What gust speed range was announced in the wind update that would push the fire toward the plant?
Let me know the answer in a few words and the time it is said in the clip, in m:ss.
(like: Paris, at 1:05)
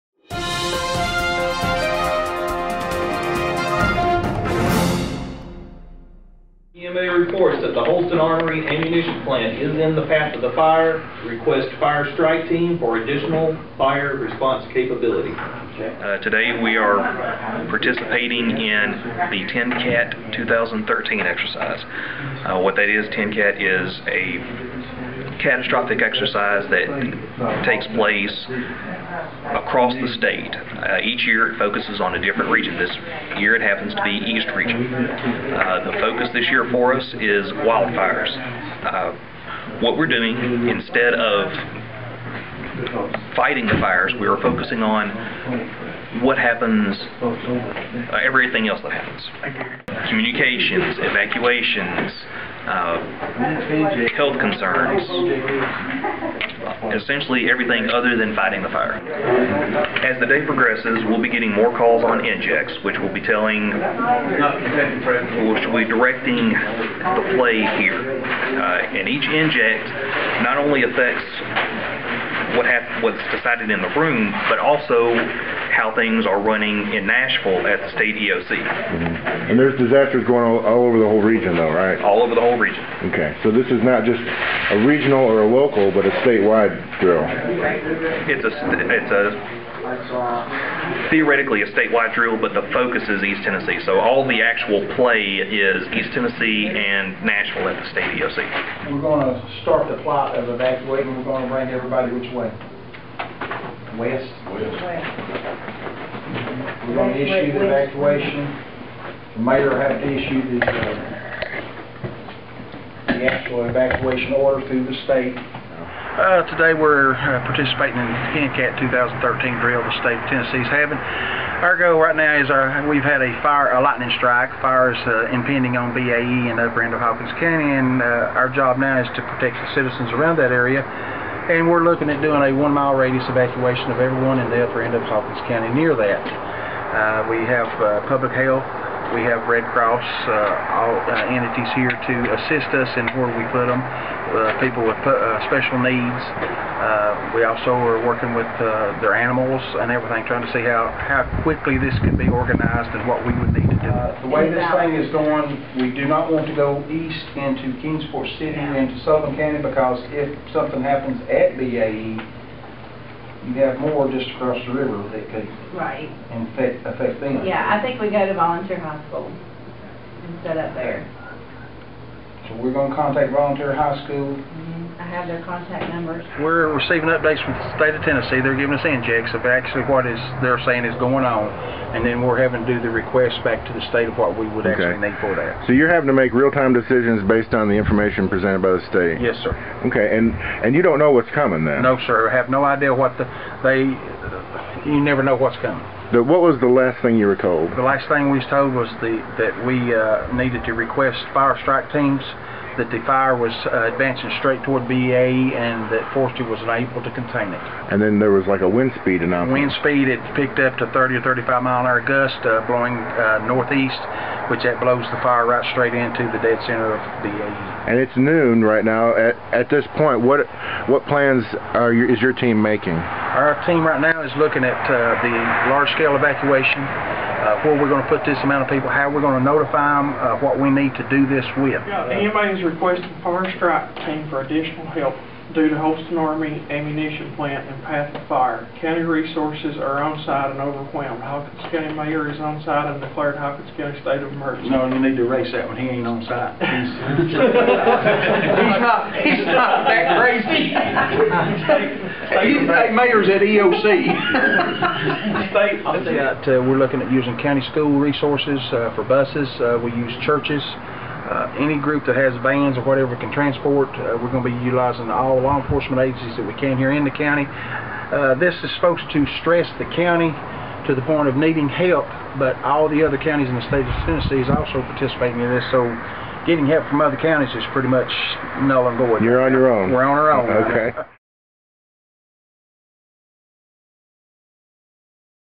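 30 or 35 mph, at 3:30.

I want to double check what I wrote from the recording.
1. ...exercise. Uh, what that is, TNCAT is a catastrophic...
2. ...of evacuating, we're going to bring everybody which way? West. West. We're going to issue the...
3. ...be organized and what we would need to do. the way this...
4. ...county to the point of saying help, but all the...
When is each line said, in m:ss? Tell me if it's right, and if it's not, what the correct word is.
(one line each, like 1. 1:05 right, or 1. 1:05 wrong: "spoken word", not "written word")
1. 0:21 right
2. 1:40 right
3. 2:32 right
4. 4:29 wrong: "needing", not "saying".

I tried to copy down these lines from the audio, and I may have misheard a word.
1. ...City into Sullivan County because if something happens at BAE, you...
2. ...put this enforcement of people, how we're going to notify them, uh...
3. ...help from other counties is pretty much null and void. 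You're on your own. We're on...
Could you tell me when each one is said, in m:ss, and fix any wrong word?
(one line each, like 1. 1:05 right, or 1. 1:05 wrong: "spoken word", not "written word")
1. 2:38 right
2. 3:48 wrong: "amount", not "enforcement"
3. 4:36 right.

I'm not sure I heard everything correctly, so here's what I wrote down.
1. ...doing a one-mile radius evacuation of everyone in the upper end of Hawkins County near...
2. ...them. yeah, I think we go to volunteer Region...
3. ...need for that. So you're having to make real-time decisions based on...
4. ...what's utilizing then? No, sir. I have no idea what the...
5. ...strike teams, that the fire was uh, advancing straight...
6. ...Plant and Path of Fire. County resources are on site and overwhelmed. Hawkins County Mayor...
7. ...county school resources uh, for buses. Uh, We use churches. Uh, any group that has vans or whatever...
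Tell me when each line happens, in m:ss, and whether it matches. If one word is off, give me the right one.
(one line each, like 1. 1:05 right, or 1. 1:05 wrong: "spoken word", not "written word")
1. 2:12 right
2. 2:47 wrong: "Hospital", not "Region"
3. 3:05 right
4. 3:11 wrong: "coming", not "utilizing"
5. 3:21 right
6. 3:57 right
7. 4:17 right.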